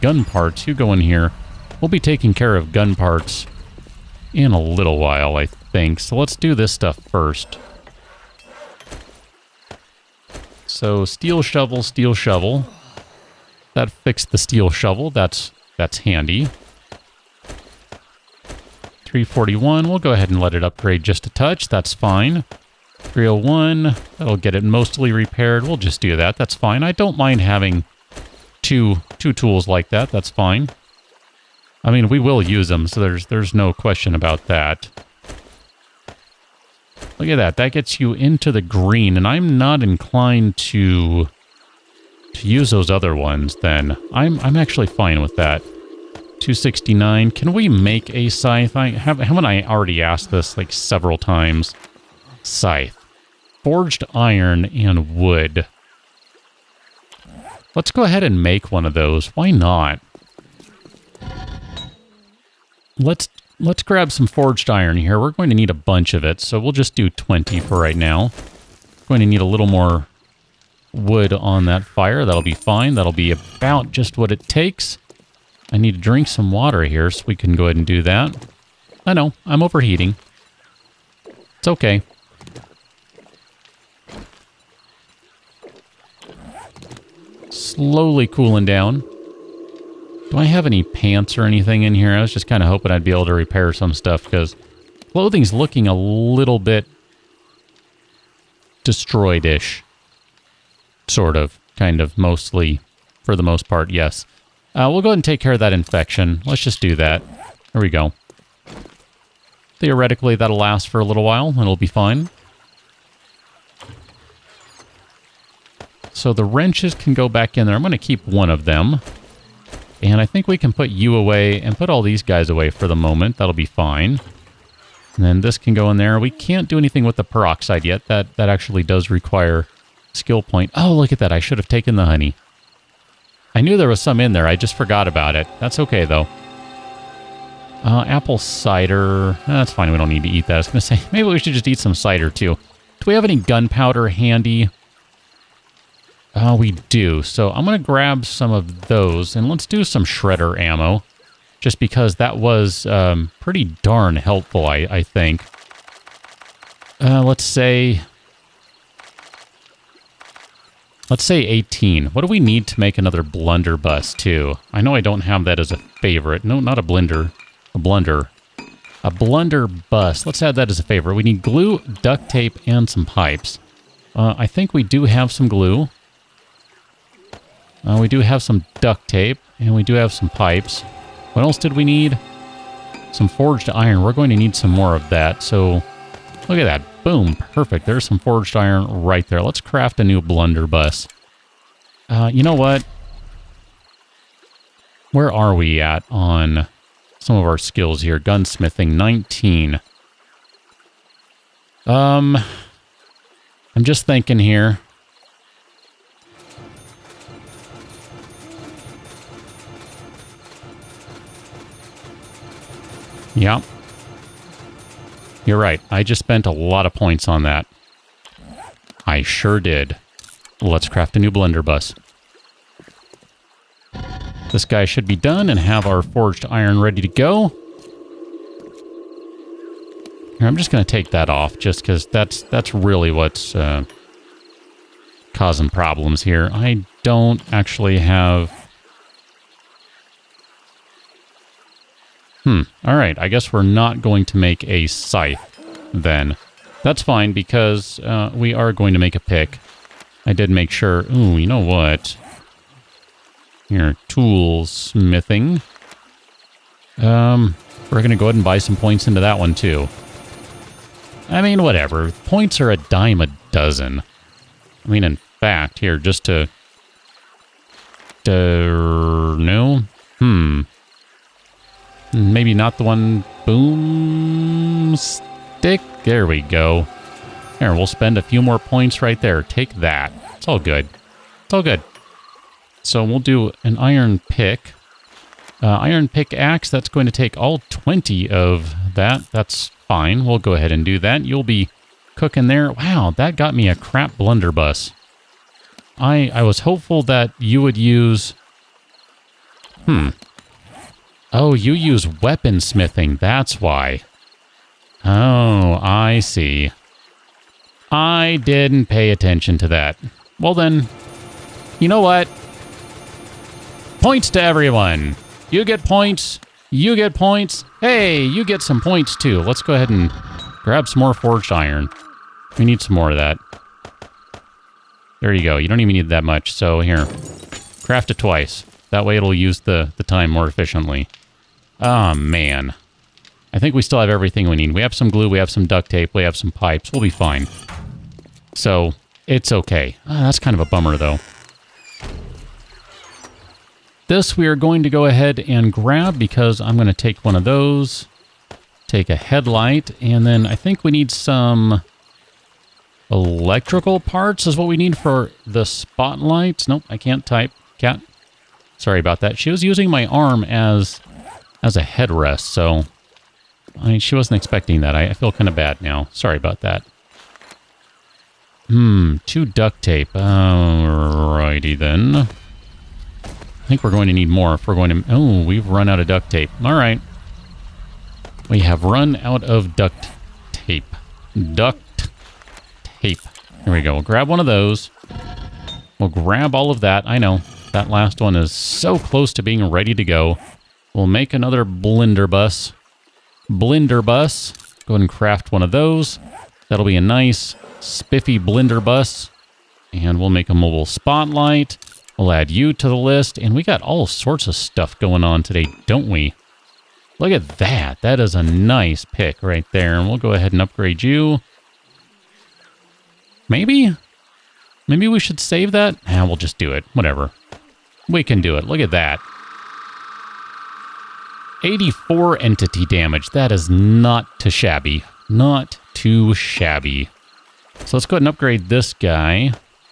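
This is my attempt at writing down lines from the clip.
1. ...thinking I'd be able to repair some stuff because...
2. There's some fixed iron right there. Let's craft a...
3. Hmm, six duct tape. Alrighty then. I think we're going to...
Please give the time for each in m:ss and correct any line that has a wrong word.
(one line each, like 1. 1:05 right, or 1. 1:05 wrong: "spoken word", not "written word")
1. 1:32 wrong: "hoping", not "thinking"
2. 3:07 wrong: "forged", not "fixed"
3. 6:08 wrong: "two", not "six".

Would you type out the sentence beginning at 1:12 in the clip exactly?
That'll be about just what it takes.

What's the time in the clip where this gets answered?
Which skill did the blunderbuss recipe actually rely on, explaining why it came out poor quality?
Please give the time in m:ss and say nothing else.
5:02.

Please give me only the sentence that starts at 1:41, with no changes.
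Sort of, kind of, mostly, for the most part, yes.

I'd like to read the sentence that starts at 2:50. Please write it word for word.
Let's add that as a favorite.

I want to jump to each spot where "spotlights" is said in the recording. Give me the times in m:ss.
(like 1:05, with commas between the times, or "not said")
5:55, 6:40.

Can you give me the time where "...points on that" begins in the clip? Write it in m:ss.
3:36.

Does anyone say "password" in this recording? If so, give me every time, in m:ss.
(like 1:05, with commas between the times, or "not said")
not said.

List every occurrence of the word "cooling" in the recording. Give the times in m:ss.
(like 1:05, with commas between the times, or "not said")
1:28.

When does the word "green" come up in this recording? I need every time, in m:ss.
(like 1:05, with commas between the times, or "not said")
0:38.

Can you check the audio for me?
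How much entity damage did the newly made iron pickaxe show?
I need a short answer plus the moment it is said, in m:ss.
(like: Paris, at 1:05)
84, at 7:01.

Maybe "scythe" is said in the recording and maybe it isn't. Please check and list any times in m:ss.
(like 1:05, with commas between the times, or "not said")
0:48, 0:52, 4:04.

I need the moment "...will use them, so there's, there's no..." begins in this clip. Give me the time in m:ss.
0:32.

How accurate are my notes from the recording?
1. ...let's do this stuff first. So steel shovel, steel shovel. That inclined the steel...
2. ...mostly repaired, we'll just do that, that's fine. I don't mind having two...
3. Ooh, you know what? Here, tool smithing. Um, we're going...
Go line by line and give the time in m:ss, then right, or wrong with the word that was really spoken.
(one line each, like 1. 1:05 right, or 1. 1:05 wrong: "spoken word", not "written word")
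1. 0:06 wrong: "fixed", not "inclined"
2. 0:24 right
3. 4:11 right.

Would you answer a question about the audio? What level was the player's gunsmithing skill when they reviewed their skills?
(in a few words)
19.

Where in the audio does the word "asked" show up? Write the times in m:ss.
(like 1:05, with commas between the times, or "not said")
0:50.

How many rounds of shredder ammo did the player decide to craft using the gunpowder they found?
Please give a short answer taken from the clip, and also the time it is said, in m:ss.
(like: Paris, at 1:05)
18, at 2:41.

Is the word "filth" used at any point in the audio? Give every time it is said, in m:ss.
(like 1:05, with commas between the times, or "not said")
not said.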